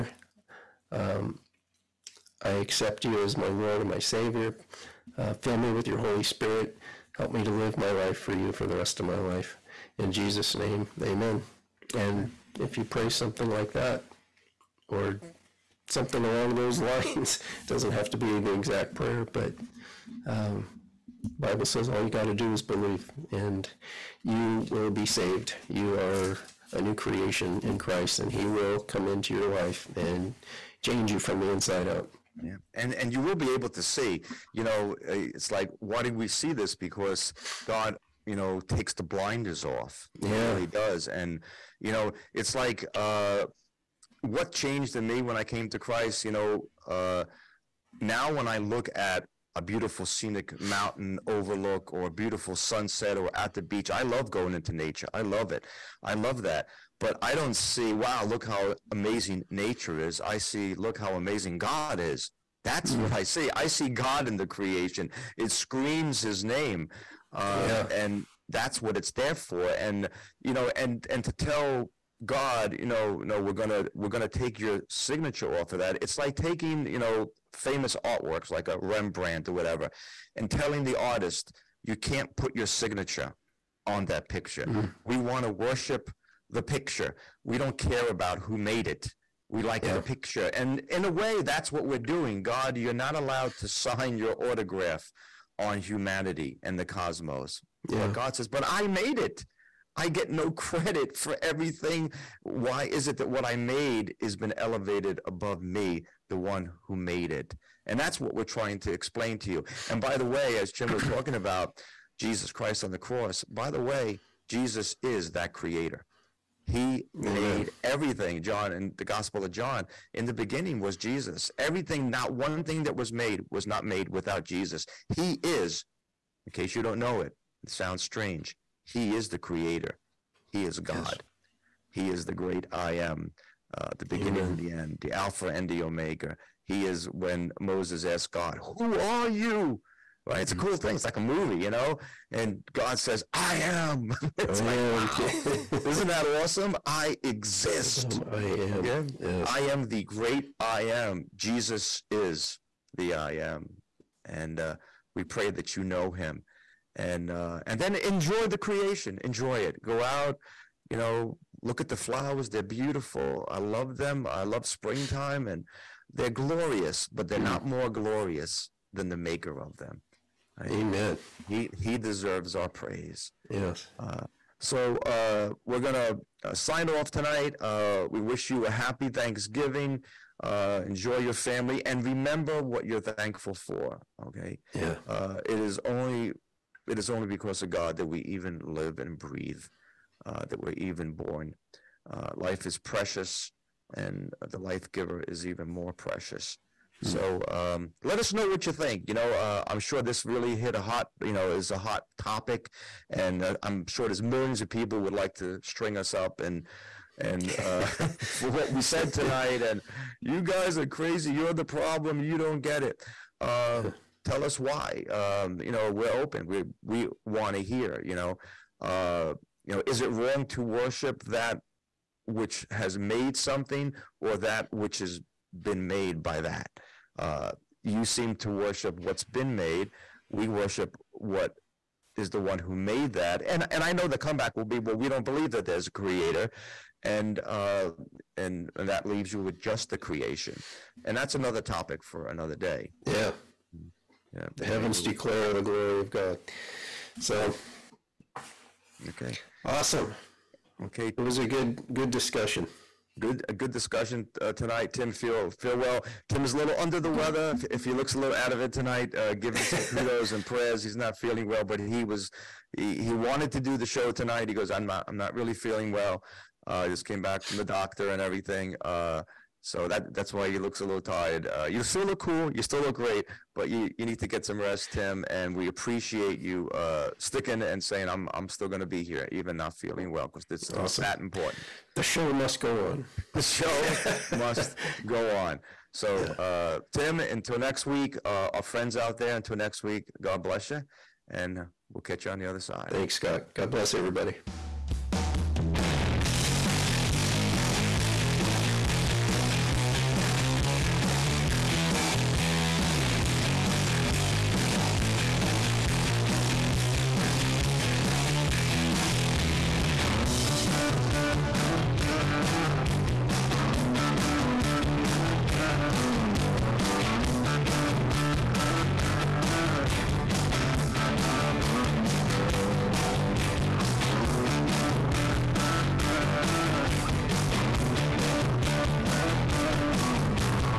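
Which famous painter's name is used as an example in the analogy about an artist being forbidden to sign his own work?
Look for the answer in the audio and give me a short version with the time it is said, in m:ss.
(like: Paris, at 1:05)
Rembrandt, at 1:18.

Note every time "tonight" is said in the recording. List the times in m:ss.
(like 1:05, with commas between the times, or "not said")
2:57, 3:29, 4:14, 4:18, 4:24.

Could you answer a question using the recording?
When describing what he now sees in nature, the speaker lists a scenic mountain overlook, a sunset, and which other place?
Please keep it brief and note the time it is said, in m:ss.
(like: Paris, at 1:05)
the beach, at 0:53.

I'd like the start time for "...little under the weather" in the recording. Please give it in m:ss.
4:16.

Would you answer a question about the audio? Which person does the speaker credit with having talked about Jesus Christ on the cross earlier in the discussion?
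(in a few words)
Jim.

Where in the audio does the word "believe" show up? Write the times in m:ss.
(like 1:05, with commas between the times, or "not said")
0:22, 3:55.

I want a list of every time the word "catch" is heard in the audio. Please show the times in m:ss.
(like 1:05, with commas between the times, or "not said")
4:52.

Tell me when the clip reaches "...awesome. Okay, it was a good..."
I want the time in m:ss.
4:09.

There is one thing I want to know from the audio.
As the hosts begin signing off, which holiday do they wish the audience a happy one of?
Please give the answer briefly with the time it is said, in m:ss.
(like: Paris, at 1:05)
Thanksgiving, at 2:59.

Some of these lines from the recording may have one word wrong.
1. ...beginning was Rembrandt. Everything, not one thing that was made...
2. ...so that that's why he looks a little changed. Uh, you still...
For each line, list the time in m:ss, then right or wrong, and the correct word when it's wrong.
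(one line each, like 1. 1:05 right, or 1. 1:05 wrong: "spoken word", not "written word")
1. 2:00 wrong: "Jesus", not "Rembrandt"
2. 4:29 wrong: "tired", not "changed".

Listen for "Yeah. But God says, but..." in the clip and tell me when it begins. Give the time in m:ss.
1:37.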